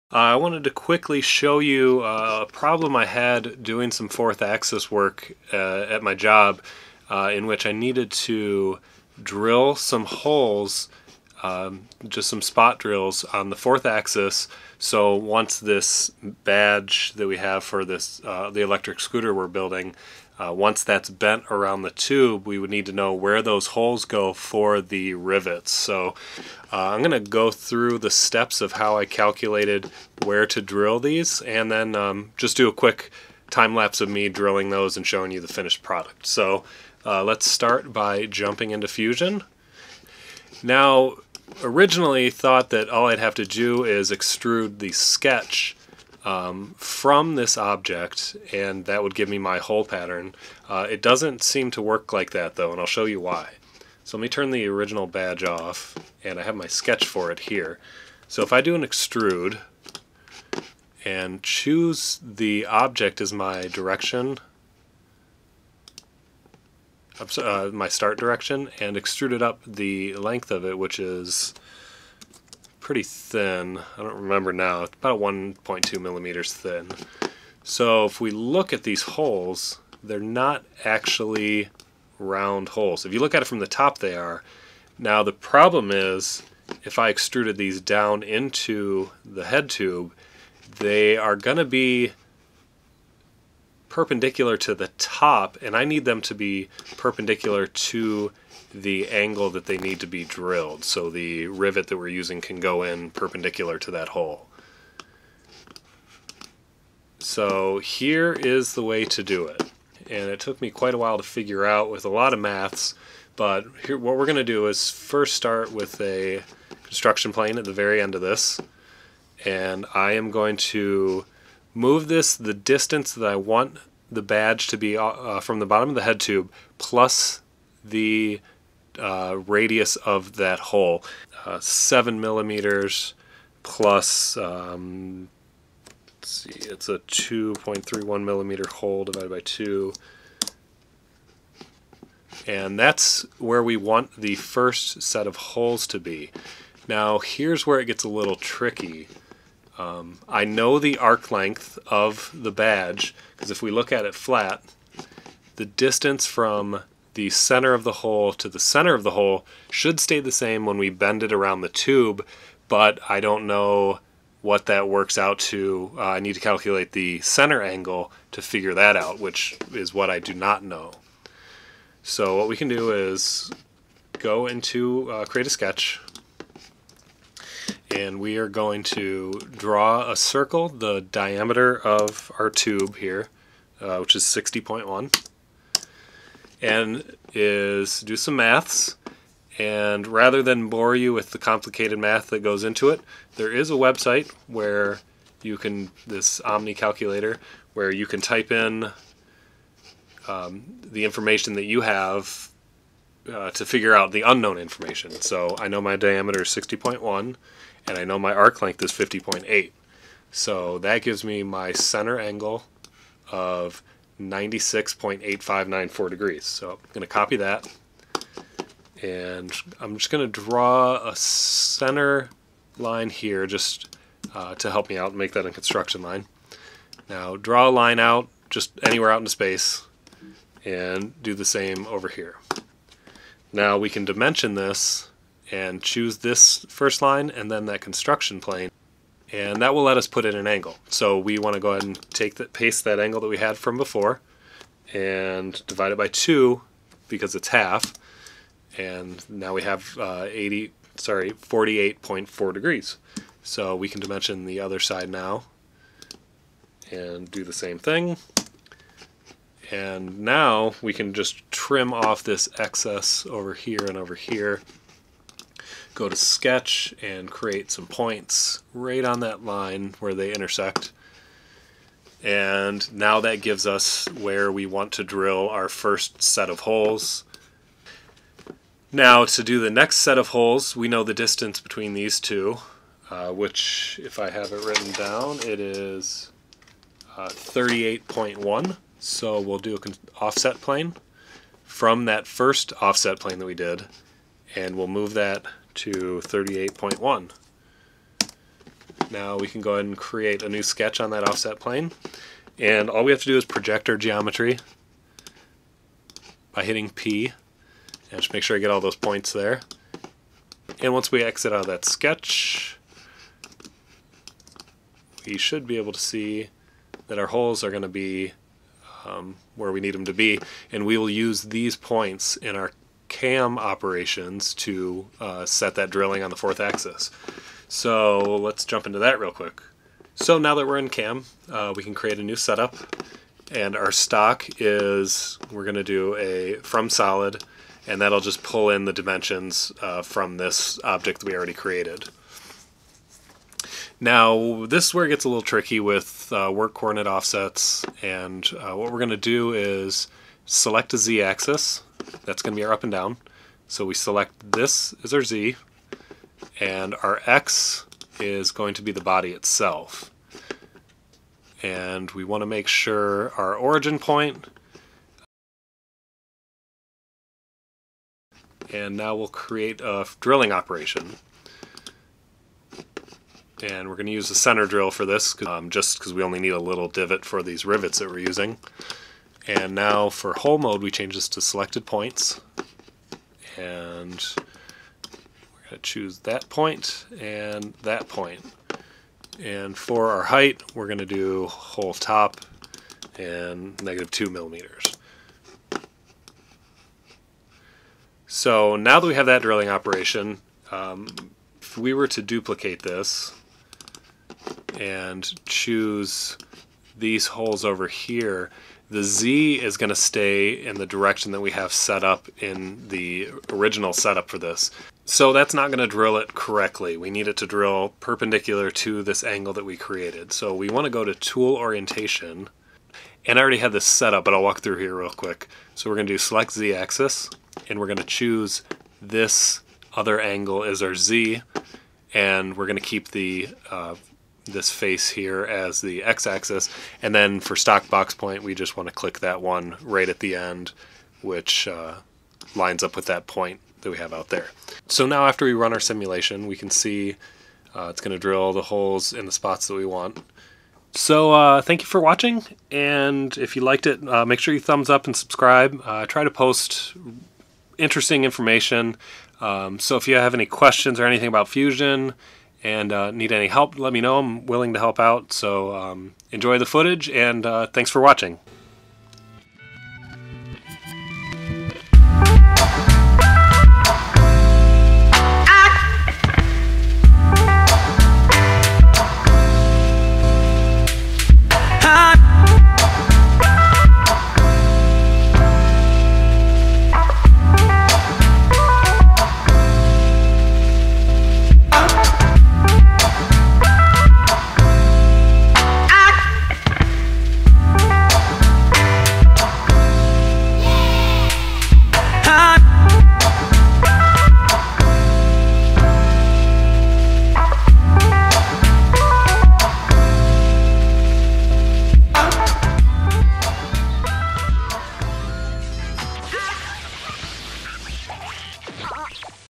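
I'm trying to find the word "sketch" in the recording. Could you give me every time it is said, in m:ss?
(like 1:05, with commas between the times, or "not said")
0:44, 0:56, 2:55, 4:26, 5:00, 5:11.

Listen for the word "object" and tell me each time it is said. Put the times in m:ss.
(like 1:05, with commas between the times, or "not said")
0:47, 1:02, 5:40.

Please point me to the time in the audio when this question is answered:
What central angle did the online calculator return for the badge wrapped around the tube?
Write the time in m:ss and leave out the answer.
3:34.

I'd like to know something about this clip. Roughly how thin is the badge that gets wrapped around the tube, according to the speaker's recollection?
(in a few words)
1.2 millimeters.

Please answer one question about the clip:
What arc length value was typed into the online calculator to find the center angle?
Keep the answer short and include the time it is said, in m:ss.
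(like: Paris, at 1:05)
50.8, at 3:28.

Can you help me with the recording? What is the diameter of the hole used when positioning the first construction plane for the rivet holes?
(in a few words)
2.31 millimeters.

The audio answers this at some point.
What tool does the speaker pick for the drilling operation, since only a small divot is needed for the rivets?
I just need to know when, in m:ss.
6:14.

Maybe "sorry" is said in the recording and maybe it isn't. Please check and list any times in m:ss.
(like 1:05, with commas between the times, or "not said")
4:10.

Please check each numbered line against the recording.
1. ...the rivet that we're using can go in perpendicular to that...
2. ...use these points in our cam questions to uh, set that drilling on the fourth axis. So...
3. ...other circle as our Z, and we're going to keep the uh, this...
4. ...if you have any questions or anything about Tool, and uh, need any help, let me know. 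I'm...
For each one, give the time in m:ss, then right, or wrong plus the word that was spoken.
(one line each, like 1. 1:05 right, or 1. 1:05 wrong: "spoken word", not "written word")
1. 1:41 right
2. 5:21 wrong: "operations", not "questions"
3. 7:09 wrong: "angle", not "circle"
4. 7:39 wrong: "Fusion", not "Tool".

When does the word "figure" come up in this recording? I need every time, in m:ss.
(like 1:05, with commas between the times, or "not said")
1:51, 2:48, 3:23.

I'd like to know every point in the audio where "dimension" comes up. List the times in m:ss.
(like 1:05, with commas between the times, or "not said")
3:54, 4:14, 5:38.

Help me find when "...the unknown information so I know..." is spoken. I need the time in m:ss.
3:24.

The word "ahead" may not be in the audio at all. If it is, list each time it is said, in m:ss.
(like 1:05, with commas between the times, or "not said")
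4:01, 4:59.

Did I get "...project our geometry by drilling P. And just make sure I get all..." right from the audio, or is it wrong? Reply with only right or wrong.
wrong.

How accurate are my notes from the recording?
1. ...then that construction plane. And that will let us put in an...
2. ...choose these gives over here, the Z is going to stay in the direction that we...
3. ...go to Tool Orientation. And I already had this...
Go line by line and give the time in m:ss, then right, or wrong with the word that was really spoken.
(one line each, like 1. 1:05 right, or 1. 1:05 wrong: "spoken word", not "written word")
1. 3:57 right
2. 6:45 wrong: "holes", not "gives"
3. 7:00 right.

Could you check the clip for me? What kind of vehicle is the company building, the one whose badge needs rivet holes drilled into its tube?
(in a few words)
Electric scooter.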